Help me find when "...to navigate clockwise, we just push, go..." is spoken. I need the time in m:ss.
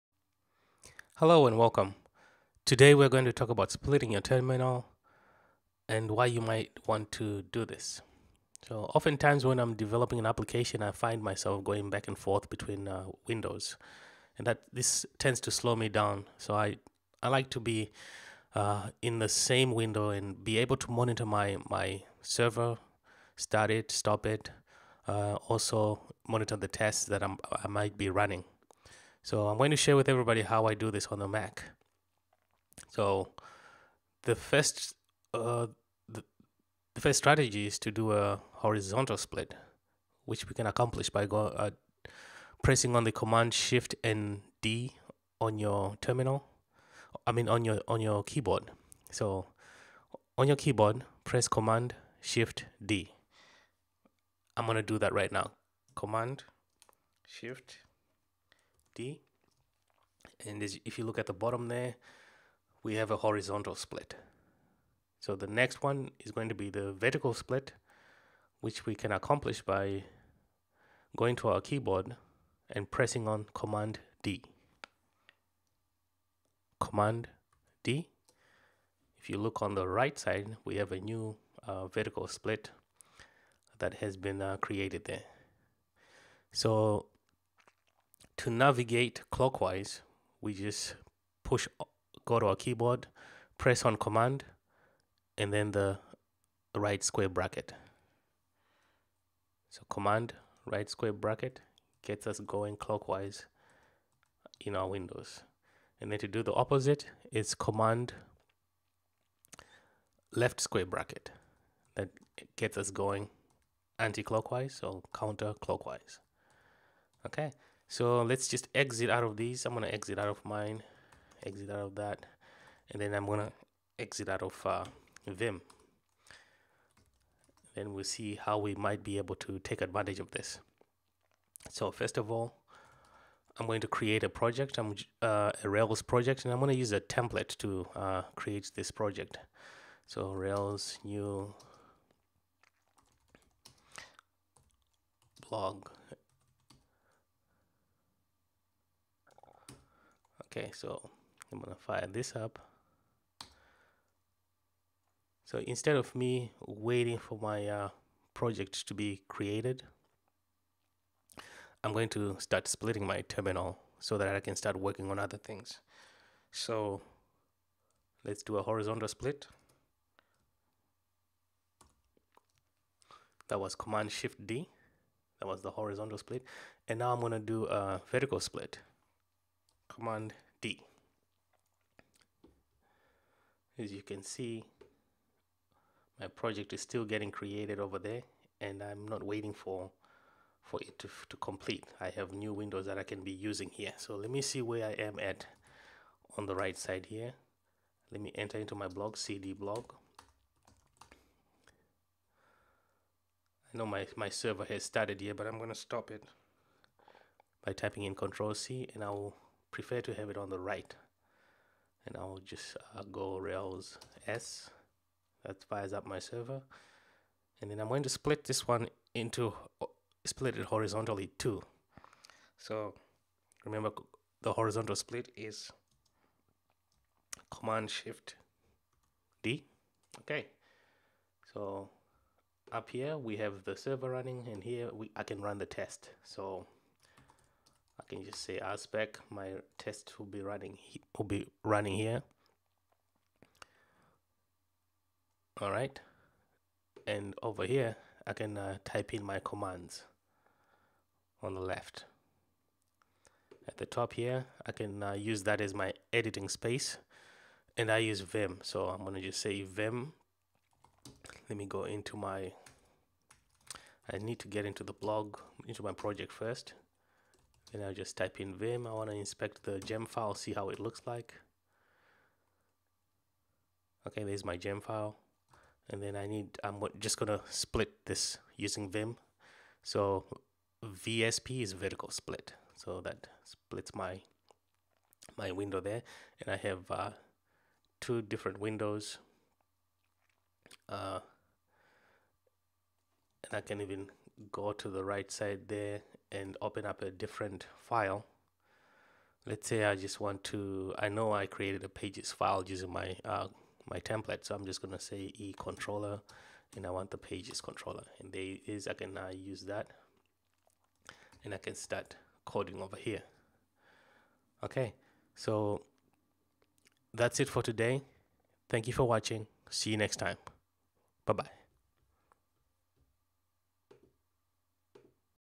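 1:28.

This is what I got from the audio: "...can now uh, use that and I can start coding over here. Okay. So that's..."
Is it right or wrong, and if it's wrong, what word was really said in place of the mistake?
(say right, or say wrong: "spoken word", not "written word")
right.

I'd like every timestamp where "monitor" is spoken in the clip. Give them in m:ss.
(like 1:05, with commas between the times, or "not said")
0:20, 0:26.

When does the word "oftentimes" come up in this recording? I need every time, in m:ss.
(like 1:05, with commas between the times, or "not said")
0:08.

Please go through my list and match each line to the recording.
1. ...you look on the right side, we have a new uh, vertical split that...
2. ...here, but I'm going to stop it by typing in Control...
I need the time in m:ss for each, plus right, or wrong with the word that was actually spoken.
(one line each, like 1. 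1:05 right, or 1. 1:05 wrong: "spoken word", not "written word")
1. 1:19 right
2. 3:25 right.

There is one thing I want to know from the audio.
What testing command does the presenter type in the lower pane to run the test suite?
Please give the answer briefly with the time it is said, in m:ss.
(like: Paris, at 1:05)
rspec, at 3:58.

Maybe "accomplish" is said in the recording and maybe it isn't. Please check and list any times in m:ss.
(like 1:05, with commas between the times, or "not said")
0:40, 1:09.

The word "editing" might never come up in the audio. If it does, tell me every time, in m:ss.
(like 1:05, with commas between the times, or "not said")
4:16.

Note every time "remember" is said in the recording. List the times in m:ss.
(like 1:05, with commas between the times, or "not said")
3:43.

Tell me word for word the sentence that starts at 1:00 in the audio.
And if you look at the bottom there, we have a horizontal split.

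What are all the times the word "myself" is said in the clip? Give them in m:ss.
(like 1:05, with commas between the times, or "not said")
0:11.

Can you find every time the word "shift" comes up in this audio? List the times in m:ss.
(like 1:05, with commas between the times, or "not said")
0:43, 0:52, 0:57, 2:54, 3:47.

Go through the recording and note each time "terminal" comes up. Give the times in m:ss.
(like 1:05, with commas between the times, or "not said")
0:04, 0:46, 2:43.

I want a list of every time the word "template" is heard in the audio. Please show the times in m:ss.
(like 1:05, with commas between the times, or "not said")
2:17, 5:03.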